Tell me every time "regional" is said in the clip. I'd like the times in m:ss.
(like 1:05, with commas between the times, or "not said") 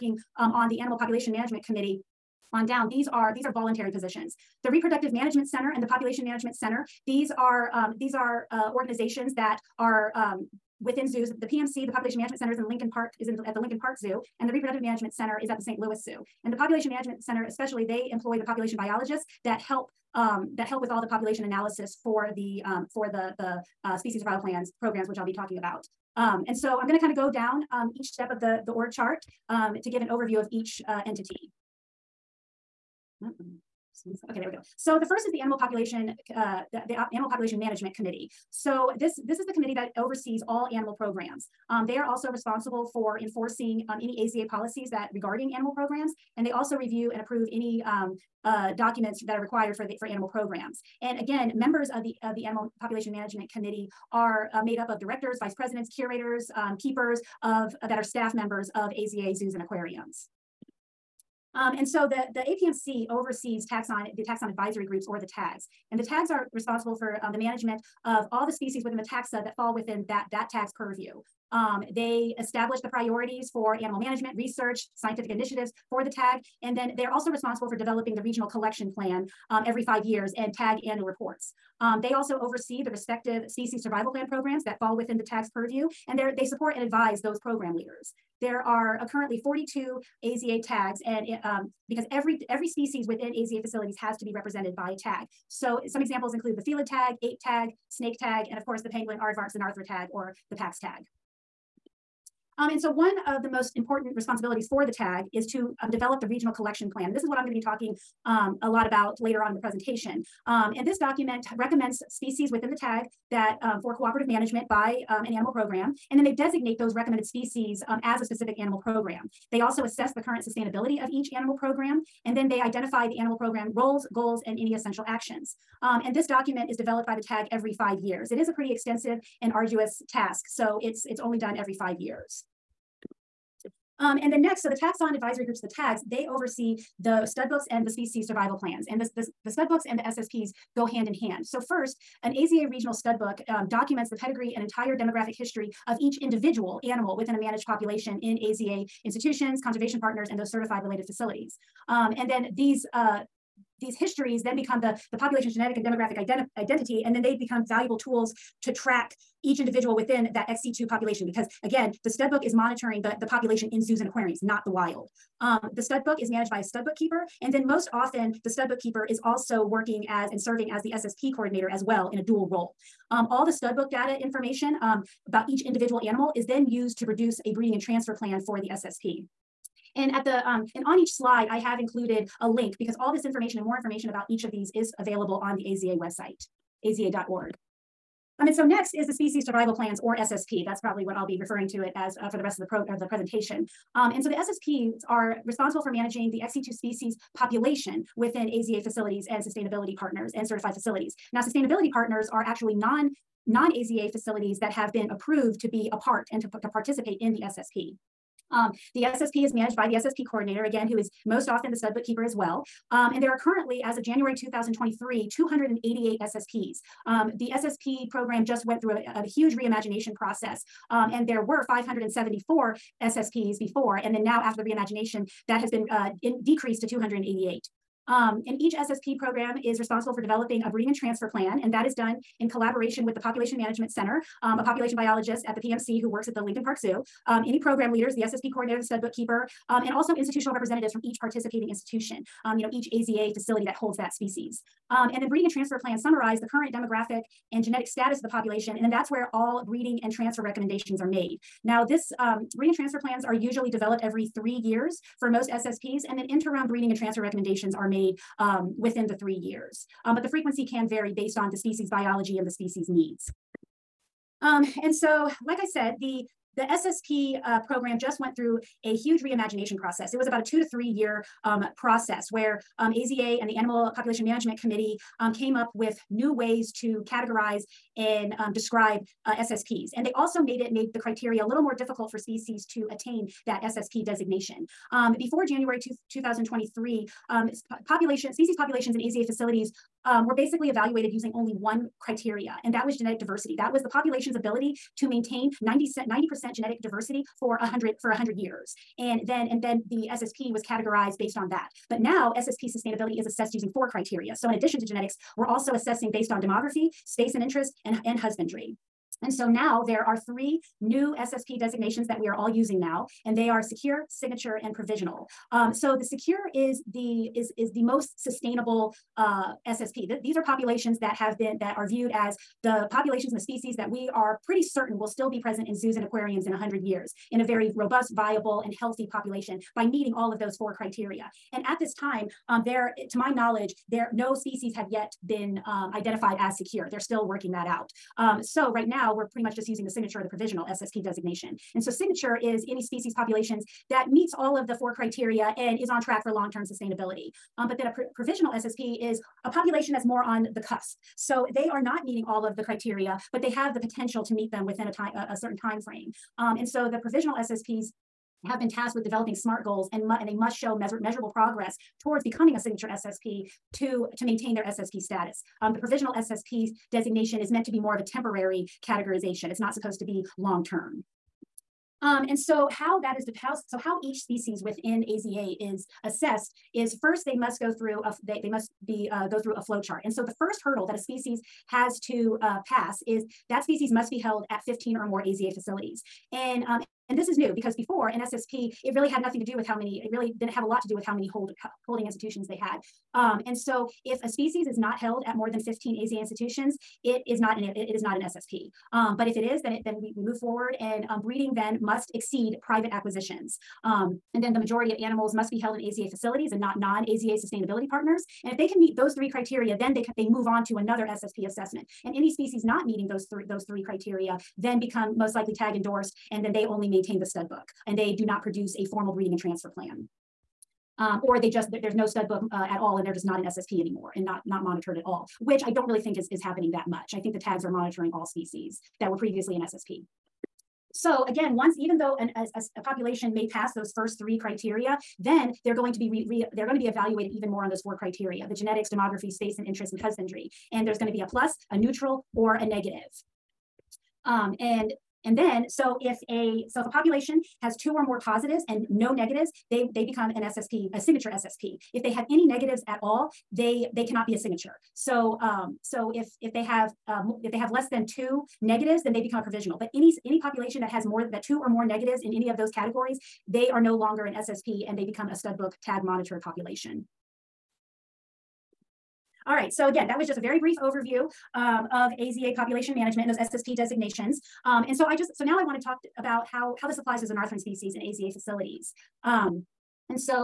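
1:18, 1:46, 2:22.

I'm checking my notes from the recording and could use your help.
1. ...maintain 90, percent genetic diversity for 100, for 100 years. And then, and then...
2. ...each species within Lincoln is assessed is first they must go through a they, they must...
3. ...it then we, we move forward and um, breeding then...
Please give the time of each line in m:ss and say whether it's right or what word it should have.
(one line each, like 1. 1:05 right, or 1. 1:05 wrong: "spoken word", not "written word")
1. 4:55 right
2. 6:14 wrong: "AZA", not "Lincoln"
3. 6:39 right.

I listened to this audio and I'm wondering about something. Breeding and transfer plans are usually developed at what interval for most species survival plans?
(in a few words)
Every three years.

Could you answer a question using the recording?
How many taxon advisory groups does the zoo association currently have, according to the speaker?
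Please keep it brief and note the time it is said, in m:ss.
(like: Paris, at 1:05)
42, at 1:29.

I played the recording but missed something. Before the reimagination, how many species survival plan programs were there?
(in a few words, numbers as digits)
574.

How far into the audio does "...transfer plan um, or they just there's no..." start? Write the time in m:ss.
6:59.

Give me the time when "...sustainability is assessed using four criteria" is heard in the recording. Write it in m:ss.
5:02.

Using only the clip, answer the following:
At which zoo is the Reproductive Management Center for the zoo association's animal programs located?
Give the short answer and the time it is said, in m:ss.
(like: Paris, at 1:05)
St. Louis Zoo, at 0:15.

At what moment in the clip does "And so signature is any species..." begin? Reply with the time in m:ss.
5:41.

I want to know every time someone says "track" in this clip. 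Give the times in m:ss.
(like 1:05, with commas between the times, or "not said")
2:38, 5:45.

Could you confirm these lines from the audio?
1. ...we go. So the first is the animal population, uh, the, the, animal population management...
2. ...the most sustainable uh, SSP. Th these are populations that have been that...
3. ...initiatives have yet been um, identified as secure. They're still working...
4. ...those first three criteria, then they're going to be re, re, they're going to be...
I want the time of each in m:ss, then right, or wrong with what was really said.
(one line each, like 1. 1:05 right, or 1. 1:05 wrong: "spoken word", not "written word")
1. 0:34 right
2. 5:17 right
3. 5:34 wrong: "species", not "initiatives"
4. 7:13 right.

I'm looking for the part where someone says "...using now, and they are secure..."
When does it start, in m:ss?
5:12.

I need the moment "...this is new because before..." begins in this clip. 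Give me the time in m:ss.
6:27.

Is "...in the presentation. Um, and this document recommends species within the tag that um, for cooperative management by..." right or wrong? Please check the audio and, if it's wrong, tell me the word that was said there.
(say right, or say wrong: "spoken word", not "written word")
right.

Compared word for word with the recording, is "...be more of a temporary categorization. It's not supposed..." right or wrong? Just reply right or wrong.
right.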